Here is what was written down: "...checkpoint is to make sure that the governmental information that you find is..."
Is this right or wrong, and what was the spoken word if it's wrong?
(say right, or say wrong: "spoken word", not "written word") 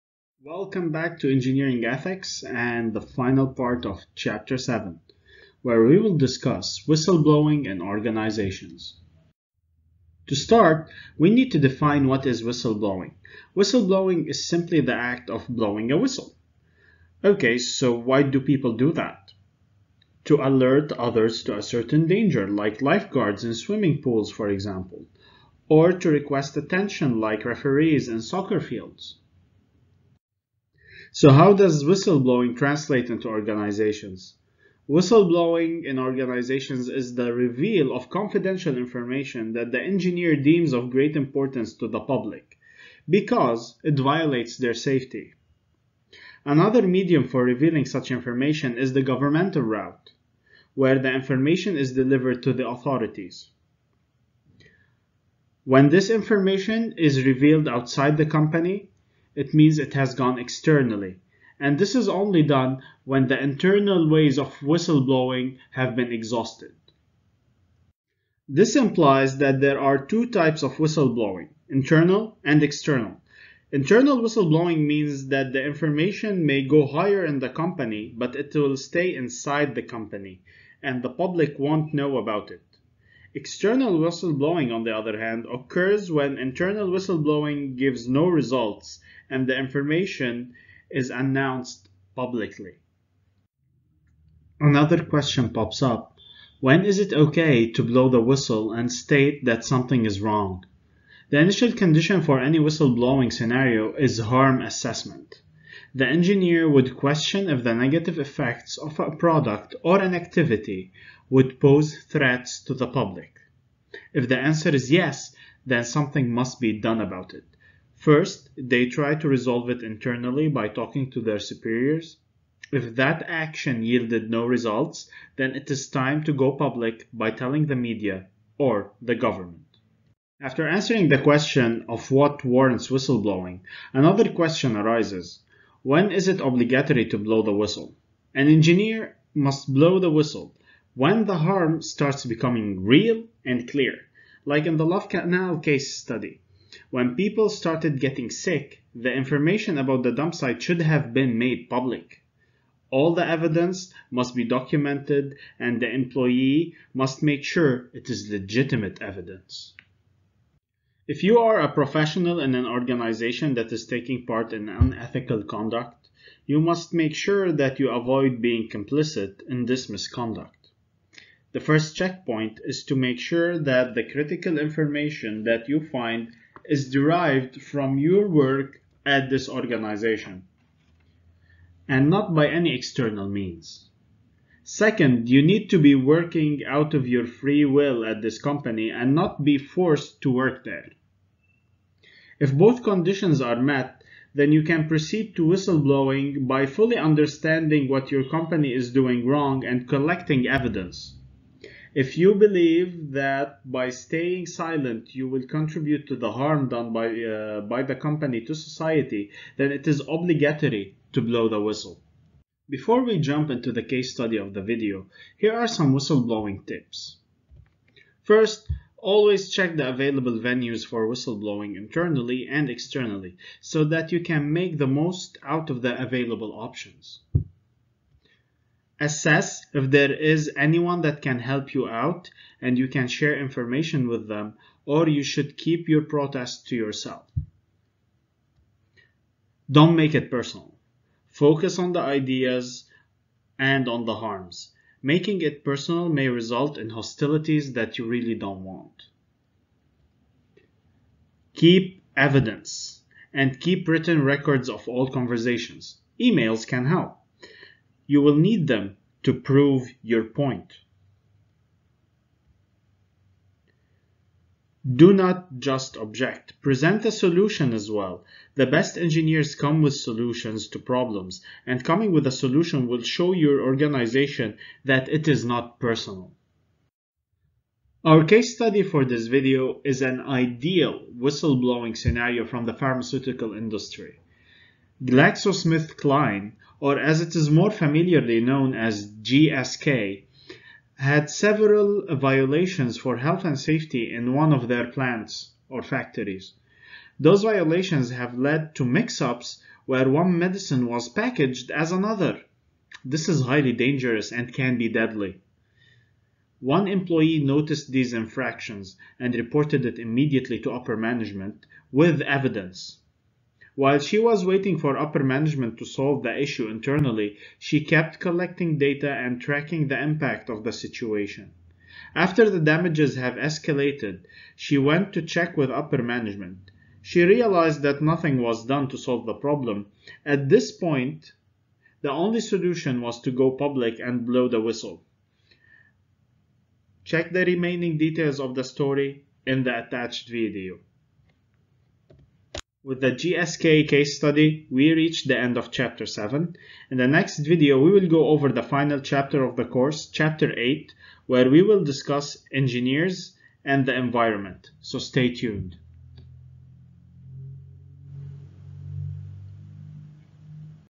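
wrong: "critical", not "governmental".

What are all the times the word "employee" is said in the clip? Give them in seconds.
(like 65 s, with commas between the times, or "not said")
155 s, 306 s.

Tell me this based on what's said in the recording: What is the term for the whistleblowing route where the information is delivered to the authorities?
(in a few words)
Governmental route.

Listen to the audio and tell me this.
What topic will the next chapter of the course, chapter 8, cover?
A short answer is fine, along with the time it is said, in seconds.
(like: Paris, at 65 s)
Engineers and the environment, at 352 s.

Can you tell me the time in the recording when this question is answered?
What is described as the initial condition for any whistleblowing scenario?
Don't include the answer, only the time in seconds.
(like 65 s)
104 s.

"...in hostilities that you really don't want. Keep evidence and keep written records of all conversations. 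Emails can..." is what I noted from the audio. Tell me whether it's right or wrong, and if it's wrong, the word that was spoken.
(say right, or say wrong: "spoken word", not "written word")
right.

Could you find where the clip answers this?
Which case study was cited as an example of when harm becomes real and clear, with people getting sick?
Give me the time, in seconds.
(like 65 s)
144 s.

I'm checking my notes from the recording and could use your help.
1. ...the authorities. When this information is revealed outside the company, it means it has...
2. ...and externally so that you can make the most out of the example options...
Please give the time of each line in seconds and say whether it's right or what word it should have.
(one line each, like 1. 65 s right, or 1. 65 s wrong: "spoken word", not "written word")
1. 52 s right
2. 222 s wrong: "available", not "example".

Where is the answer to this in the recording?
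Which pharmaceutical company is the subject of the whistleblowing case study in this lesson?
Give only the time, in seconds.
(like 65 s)
285 s.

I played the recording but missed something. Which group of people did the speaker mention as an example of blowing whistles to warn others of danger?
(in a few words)
Lifeguards.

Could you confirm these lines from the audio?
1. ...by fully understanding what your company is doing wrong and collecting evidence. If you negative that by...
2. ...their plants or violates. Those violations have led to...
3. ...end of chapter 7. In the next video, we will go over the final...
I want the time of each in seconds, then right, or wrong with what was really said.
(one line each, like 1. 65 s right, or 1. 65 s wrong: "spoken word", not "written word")
1. 196 s wrong: "believe", not "negative"
2. 294 s wrong: "factories", not "violates"
3. 345 s right.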